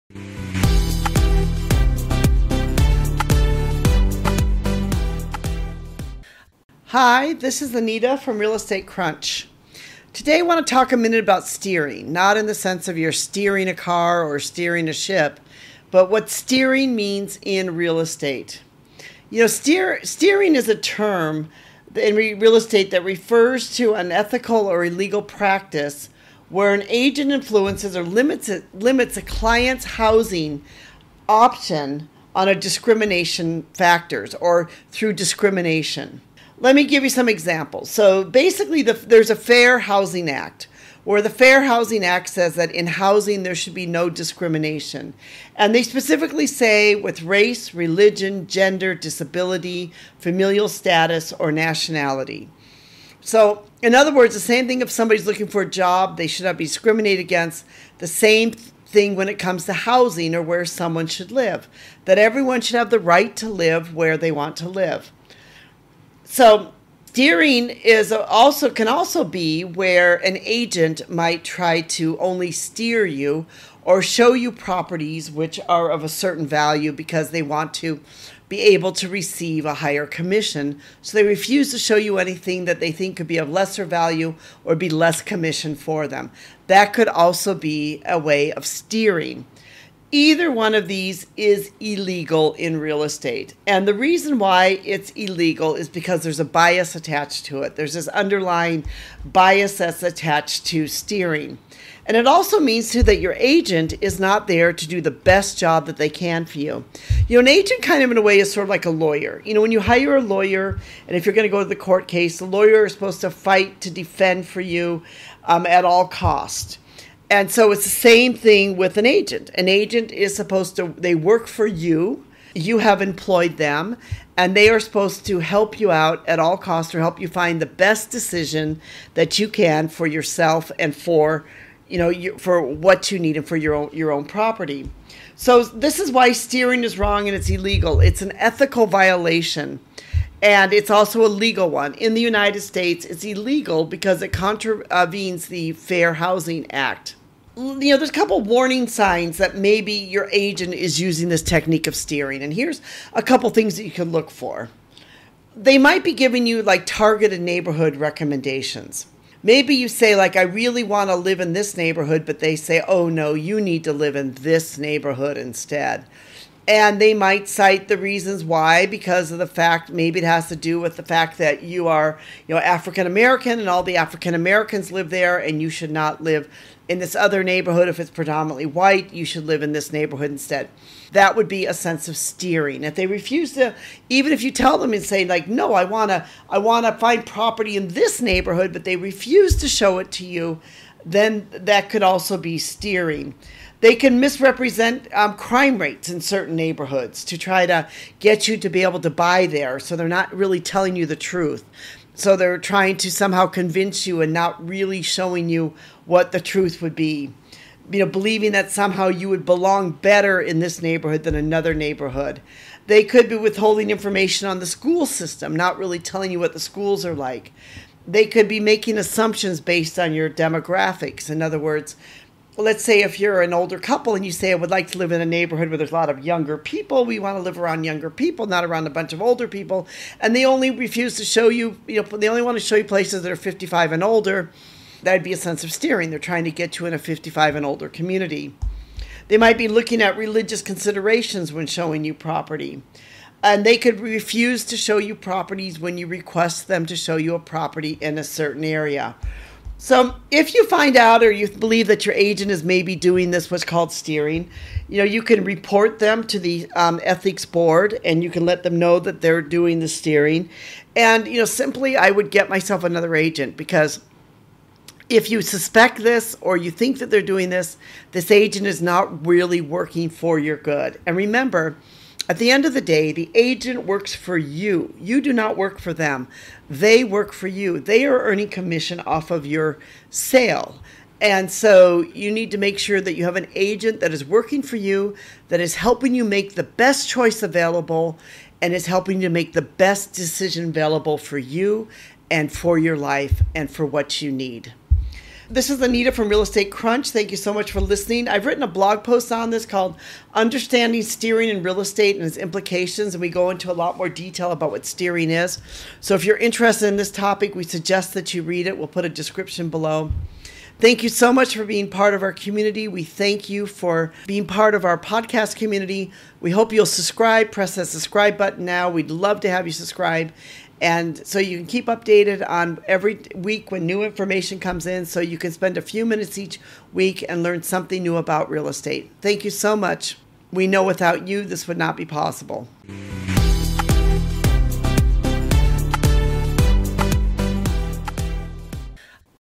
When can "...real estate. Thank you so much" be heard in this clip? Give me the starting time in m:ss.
5:28.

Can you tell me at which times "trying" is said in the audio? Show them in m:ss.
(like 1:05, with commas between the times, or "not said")
3:22, 3:56.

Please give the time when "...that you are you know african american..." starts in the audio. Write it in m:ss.
2:51.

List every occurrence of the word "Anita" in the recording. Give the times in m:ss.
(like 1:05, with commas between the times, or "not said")
0:07, 4:55.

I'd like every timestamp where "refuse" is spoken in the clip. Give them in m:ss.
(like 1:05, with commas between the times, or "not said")
1:21, 3:03, 3:08, 3:50, 4:04.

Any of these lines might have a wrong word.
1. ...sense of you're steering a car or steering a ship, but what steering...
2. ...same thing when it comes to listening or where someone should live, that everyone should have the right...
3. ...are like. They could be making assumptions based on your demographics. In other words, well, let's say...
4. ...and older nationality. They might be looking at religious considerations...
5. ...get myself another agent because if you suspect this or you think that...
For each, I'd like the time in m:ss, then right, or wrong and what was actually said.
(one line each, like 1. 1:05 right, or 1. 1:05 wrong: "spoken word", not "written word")
1. 0:12 right
2. 0:58 wrong: "housing", not "listening"
3. 3:37 right
4. 3:57 wrong: "community", not "nationality"
5. 4:22 right.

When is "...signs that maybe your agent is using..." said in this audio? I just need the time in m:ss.
2:28.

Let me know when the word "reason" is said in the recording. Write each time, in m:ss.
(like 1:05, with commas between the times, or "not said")
1:33, 2:47.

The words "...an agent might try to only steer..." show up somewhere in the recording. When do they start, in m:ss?
1:10.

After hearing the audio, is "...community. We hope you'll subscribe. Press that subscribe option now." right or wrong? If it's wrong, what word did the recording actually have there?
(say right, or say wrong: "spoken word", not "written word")
wrong: "button", not "option".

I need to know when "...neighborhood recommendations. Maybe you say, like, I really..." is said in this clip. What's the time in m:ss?
2:37.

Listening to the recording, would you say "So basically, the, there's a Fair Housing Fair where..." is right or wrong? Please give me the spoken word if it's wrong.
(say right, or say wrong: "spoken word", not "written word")
wrong: "Act", not "Fair".